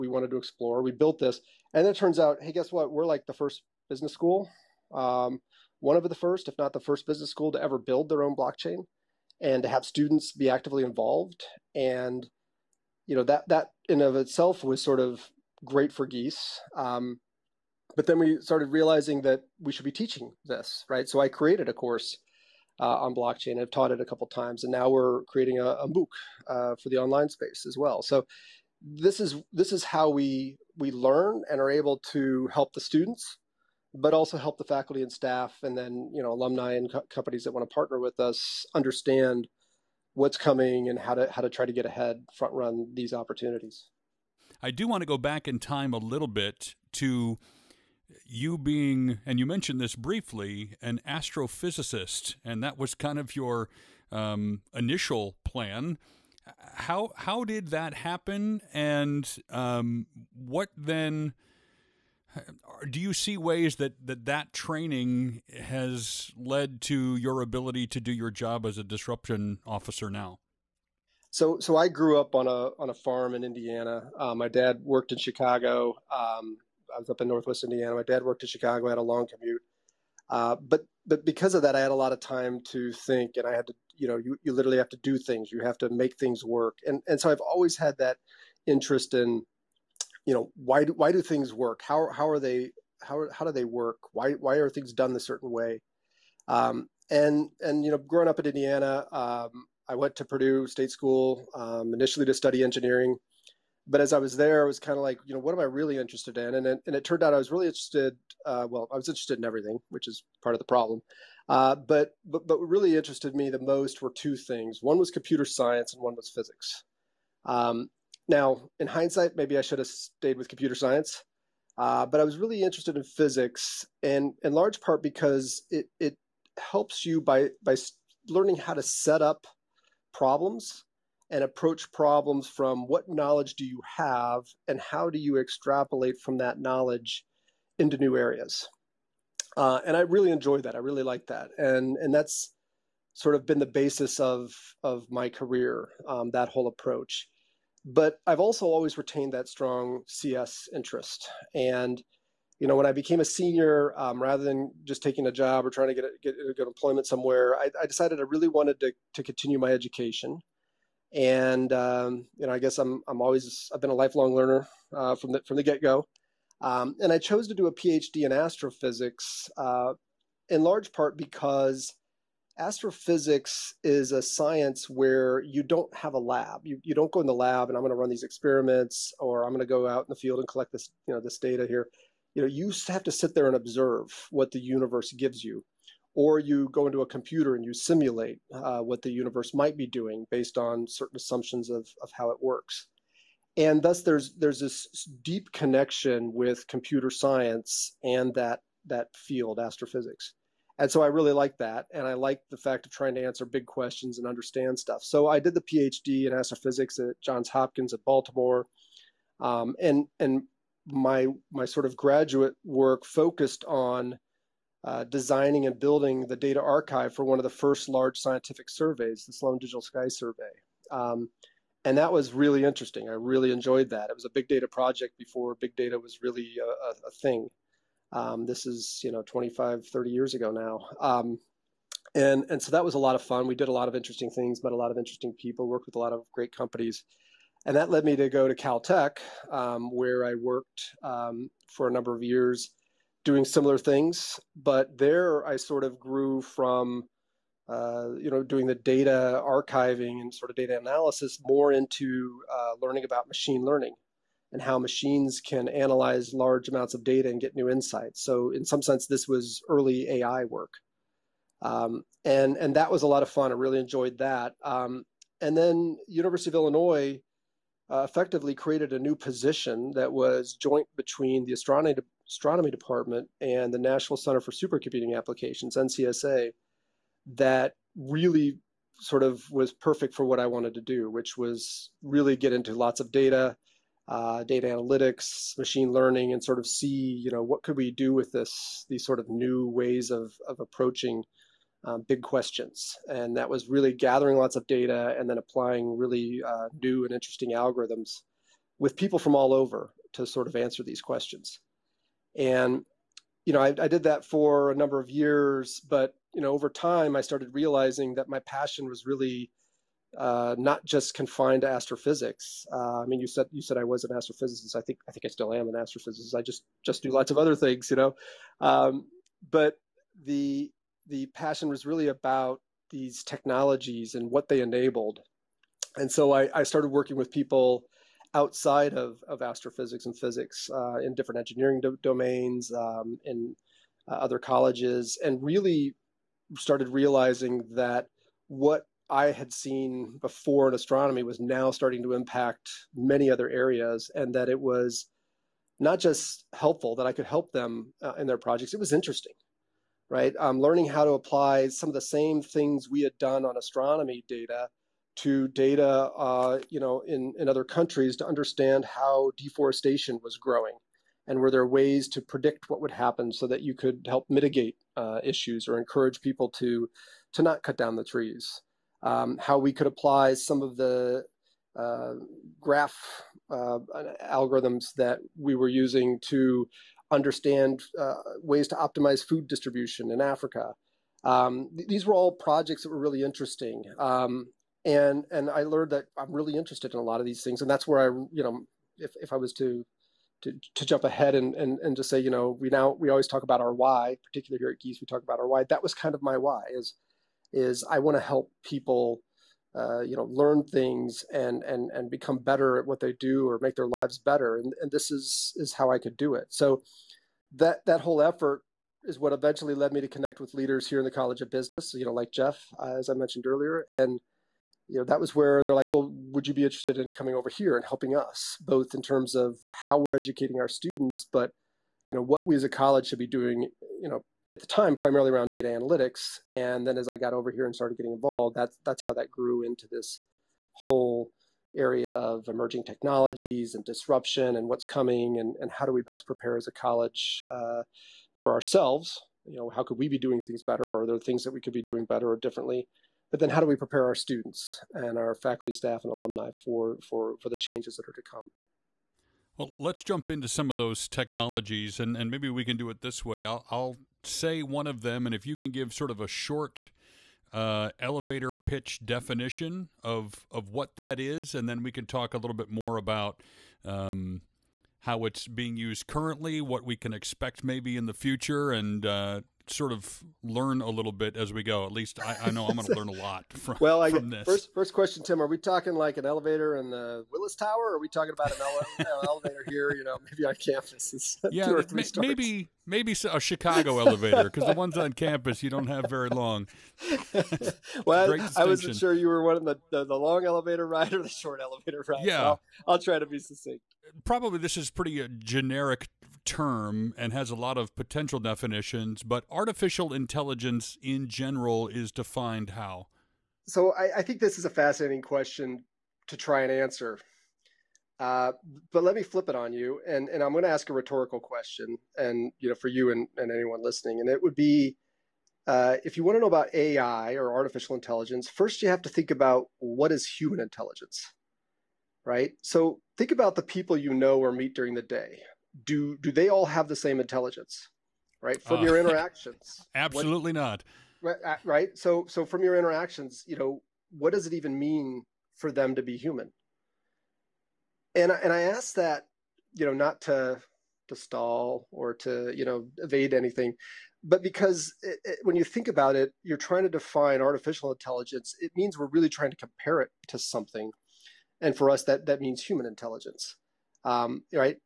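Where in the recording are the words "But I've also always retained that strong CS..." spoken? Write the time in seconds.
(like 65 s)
147 s.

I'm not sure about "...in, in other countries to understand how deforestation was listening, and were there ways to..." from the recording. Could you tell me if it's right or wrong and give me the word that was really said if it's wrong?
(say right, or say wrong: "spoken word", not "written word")
wrong: "growing", not "listening".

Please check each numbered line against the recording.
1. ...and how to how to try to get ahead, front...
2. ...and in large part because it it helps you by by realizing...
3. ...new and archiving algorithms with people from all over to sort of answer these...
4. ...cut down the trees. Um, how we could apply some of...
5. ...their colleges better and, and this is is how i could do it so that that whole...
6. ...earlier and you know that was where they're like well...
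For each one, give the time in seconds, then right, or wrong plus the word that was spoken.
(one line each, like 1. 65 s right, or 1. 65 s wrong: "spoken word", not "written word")
1. 40 s right
2. 124 s wrong: "learning", not "realizing"
3. 296 s wrong: "interesting", not "archiving"
4. 367 s right
5. 403 s wrong: "lives", not "colleges"
6. 413 s right.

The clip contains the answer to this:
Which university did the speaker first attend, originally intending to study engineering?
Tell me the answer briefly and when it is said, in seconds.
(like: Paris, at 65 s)
Purdue, at 100 s.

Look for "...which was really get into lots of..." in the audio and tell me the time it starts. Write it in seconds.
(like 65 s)
281 s.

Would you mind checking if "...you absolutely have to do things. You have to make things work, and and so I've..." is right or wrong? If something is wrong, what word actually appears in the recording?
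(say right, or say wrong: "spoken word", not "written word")
wrong: "literally", not "absolutely".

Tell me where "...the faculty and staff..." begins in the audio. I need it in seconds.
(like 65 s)
34 s.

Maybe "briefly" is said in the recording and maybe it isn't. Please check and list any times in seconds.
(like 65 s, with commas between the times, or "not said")
49 s.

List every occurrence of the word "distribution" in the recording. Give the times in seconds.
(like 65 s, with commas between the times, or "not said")
379 s.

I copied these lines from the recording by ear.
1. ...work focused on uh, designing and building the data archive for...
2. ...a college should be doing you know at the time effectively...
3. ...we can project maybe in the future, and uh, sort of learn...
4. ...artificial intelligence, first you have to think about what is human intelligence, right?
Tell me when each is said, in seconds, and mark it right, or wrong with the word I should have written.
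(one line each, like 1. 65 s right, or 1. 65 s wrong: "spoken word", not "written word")
1. 212 s right
2. 422 s wrong: "primarily", not "effectively"
3. 466 s wrong: "expect", not "project"
4. 517 s right.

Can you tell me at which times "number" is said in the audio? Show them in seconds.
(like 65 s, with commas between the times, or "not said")
241 s, 304 s.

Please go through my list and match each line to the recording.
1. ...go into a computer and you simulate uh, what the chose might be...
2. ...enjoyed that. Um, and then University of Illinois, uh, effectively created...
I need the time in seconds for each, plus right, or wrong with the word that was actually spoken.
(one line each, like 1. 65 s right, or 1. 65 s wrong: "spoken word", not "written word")
1. 186 s wrong: "universe", not "chose"
2. 263 s right.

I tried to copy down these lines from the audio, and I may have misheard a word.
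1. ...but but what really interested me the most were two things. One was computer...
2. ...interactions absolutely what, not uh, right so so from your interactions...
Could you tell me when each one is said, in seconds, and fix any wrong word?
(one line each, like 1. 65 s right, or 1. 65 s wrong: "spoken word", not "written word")
1. 112 s right
2. 528 s right.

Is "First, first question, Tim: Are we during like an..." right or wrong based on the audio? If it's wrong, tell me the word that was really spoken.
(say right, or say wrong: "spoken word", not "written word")
wrong: "talking", not "during".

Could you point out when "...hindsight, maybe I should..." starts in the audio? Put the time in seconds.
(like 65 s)
118 s.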